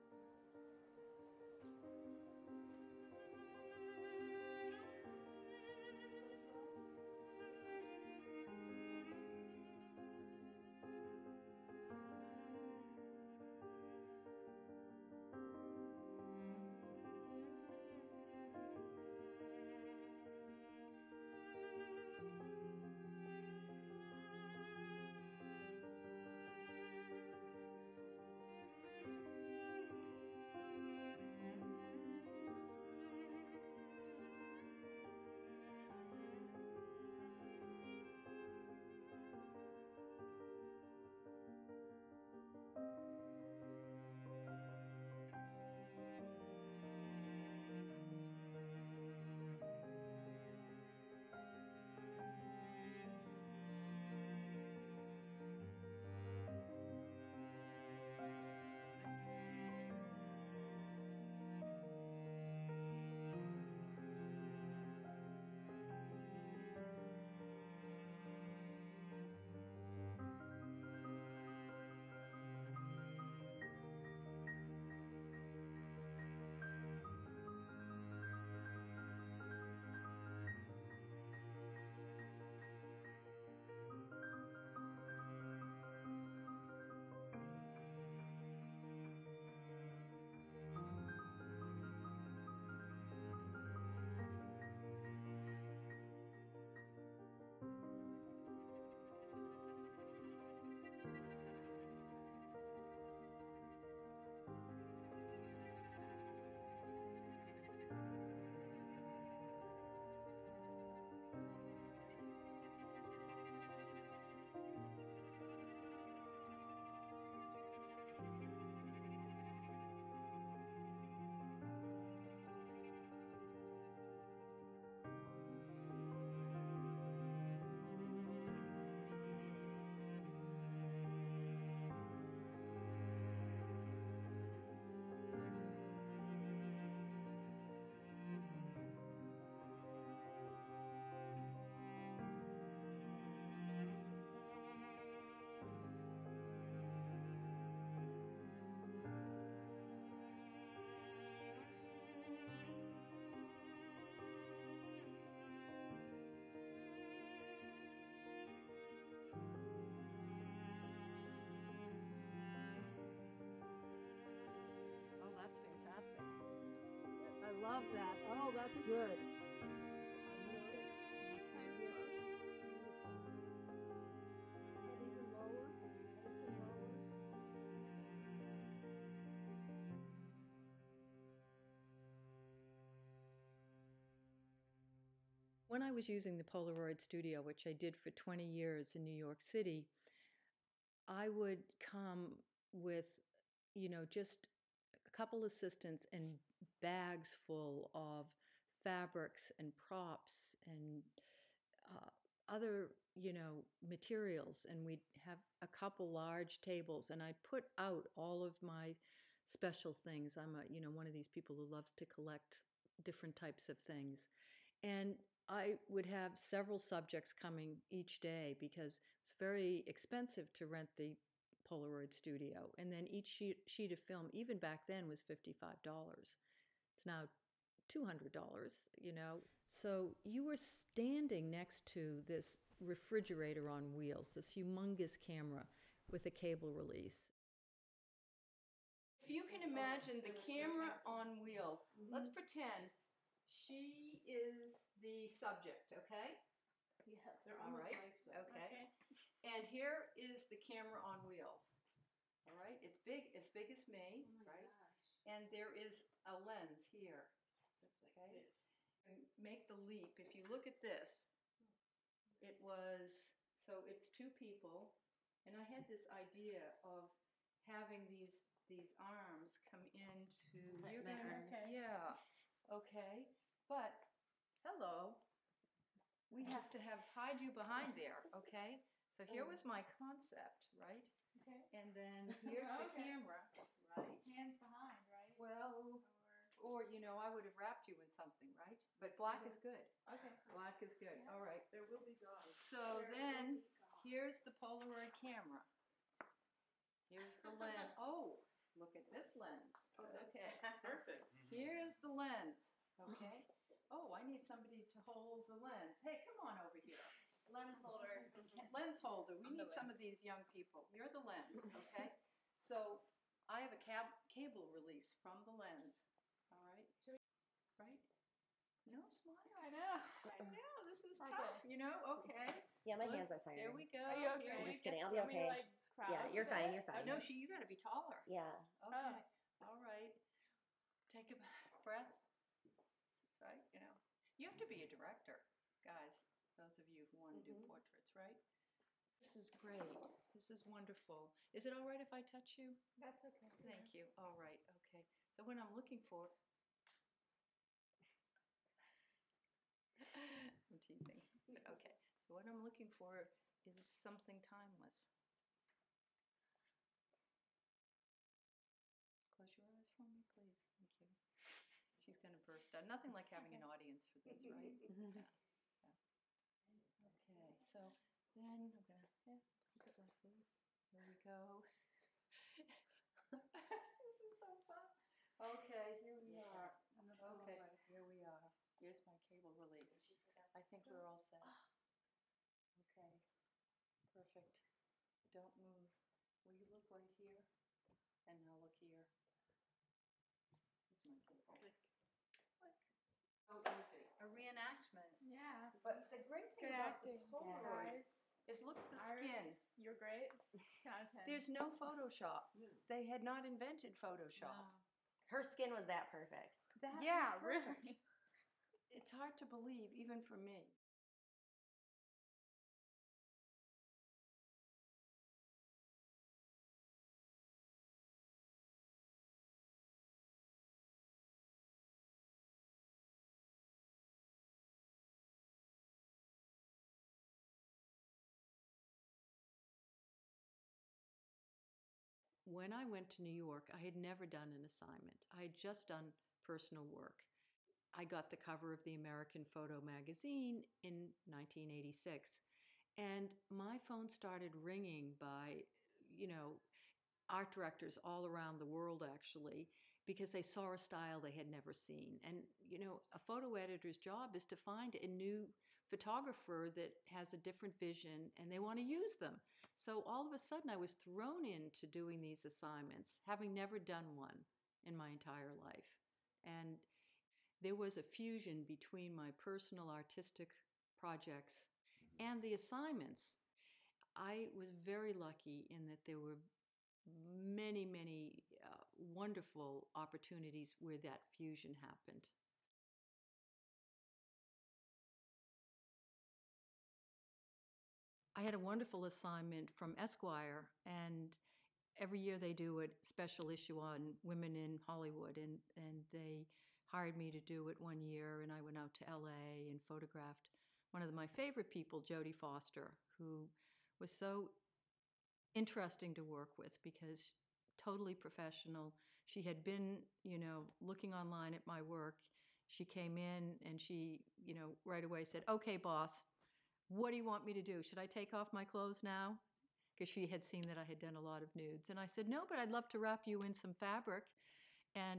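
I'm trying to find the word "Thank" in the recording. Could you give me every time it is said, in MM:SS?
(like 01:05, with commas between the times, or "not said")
05:43, 06:00.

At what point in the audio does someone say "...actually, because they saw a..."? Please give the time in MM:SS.
07:29.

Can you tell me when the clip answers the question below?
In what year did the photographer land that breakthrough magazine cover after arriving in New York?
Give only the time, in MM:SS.
07:21.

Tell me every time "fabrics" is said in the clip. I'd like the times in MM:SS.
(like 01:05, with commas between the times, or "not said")
03:18, 08:43.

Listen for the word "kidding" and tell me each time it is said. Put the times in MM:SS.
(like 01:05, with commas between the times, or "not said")
05:24.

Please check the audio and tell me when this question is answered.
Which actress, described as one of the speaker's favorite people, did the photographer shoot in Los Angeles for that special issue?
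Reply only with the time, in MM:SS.
08:22.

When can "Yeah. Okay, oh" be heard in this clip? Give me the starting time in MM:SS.
05:28.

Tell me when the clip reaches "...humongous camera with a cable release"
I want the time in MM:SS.
03:54.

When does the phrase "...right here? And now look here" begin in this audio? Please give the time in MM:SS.
06:26.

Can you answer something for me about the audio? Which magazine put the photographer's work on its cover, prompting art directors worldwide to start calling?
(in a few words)
American Photo.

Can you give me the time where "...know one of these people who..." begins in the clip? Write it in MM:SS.
03:30.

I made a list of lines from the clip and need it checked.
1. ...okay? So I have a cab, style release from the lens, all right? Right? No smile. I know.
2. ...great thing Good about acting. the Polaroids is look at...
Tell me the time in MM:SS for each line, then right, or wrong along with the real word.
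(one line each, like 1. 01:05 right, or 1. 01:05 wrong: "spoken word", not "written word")
1. 05:11 wrong: "cable", not "style"
2. 06:36 right.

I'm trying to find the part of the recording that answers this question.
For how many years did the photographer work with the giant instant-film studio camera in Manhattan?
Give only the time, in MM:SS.
03:08.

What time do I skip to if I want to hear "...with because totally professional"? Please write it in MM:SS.
08:26.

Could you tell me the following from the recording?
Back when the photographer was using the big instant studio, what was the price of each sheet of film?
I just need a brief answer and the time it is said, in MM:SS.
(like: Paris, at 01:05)
$55, at 03:45.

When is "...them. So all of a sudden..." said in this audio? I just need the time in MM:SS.
07:39.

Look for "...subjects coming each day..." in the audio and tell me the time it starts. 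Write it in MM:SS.
03:36.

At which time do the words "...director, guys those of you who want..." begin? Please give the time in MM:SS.
05:34.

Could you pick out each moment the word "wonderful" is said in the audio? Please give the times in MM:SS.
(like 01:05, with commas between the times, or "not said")
05:40, 07:58, 08:08.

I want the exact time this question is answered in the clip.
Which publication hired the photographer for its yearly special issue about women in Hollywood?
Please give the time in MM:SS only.
08:09.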